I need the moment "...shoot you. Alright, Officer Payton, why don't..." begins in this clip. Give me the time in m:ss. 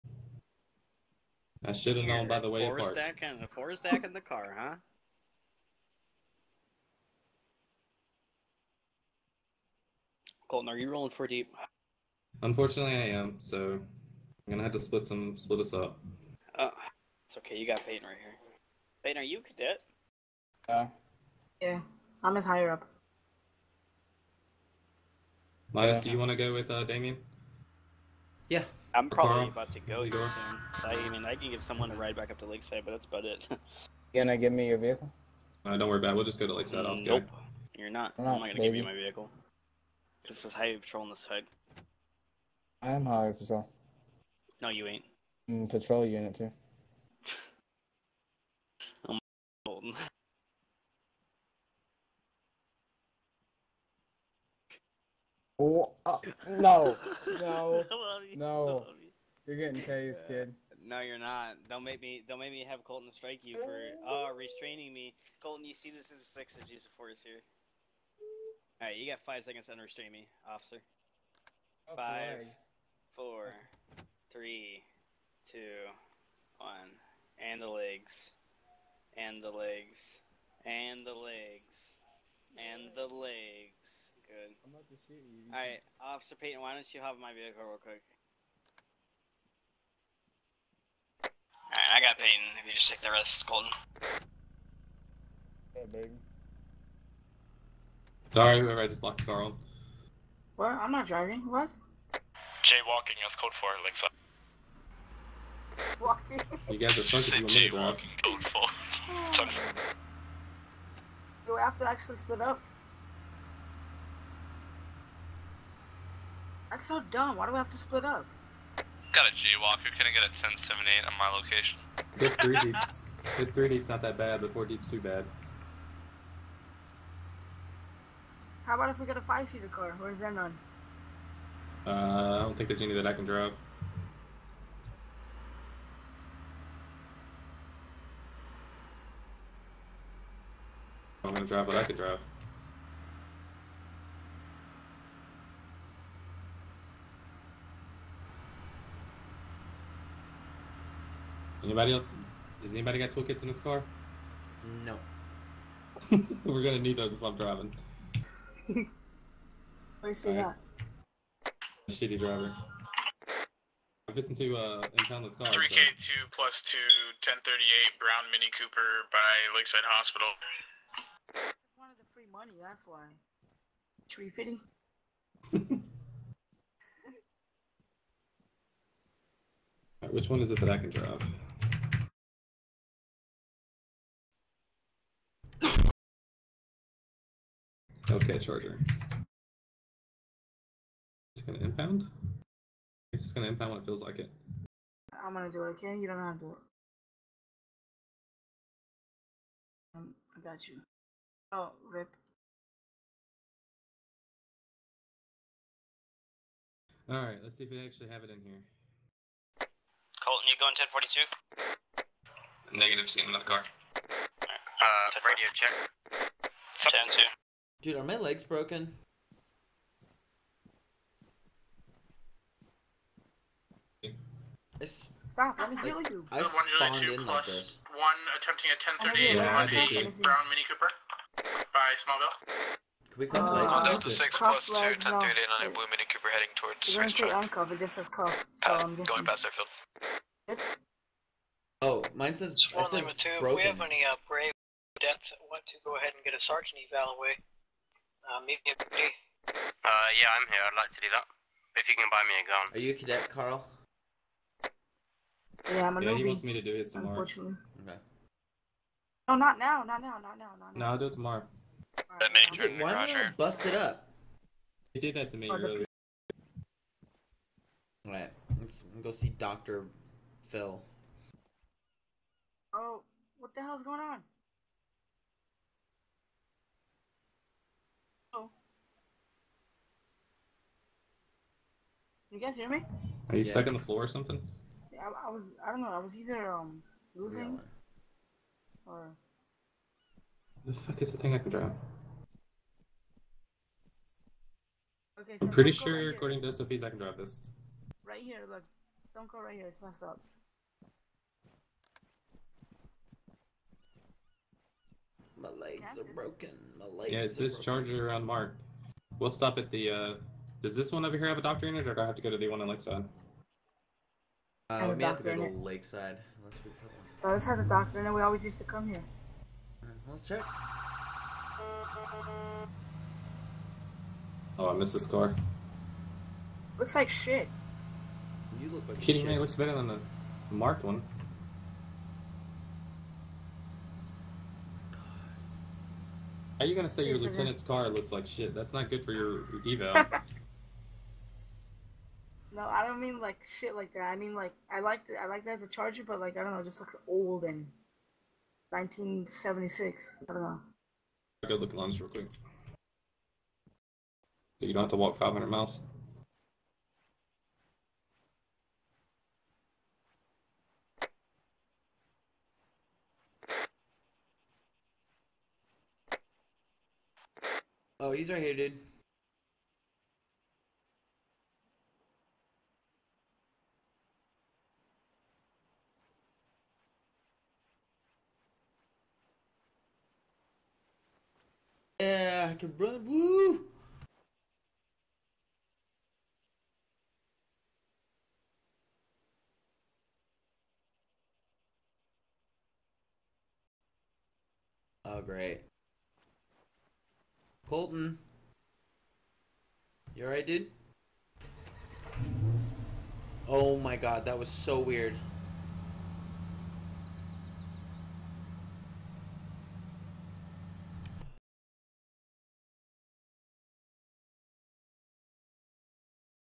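1:25.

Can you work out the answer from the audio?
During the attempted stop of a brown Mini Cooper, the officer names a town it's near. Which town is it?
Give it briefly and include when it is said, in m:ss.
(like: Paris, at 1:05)
Smallville, at 3:52.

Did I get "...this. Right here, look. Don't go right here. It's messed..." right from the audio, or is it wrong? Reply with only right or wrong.
right.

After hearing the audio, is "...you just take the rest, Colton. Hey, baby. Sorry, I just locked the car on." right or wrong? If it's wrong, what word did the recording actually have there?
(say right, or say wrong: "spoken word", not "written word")
right.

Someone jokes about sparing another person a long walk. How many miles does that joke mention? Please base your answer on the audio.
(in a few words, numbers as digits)
500.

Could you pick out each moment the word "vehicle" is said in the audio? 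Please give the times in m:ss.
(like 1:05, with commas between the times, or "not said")
0:34, 0:38, 1:27.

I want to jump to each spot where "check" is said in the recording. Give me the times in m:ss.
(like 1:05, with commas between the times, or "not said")
3:35, 5:20.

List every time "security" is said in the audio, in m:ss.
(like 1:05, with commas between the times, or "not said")
not said.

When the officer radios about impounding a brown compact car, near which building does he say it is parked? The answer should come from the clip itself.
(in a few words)
Lakeside Hospital.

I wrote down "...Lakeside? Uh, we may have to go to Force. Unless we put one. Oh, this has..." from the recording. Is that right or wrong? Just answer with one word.
wrong.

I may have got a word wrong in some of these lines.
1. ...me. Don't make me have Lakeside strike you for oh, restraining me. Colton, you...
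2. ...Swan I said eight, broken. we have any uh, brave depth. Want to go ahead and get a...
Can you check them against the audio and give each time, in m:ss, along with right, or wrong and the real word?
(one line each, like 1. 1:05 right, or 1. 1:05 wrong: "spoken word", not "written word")
1. 1:02 wrong: "Colton", not "Lakeside"
2. 4:02 wrong: "two", not "eight".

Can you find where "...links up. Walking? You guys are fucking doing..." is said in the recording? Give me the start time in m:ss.
1:43.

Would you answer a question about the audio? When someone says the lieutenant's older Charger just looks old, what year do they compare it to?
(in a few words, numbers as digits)
1976.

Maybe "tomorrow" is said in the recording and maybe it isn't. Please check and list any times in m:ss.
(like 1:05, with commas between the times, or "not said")
4:16, 4:21.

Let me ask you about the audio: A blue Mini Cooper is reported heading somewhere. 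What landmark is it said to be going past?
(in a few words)
Airfield.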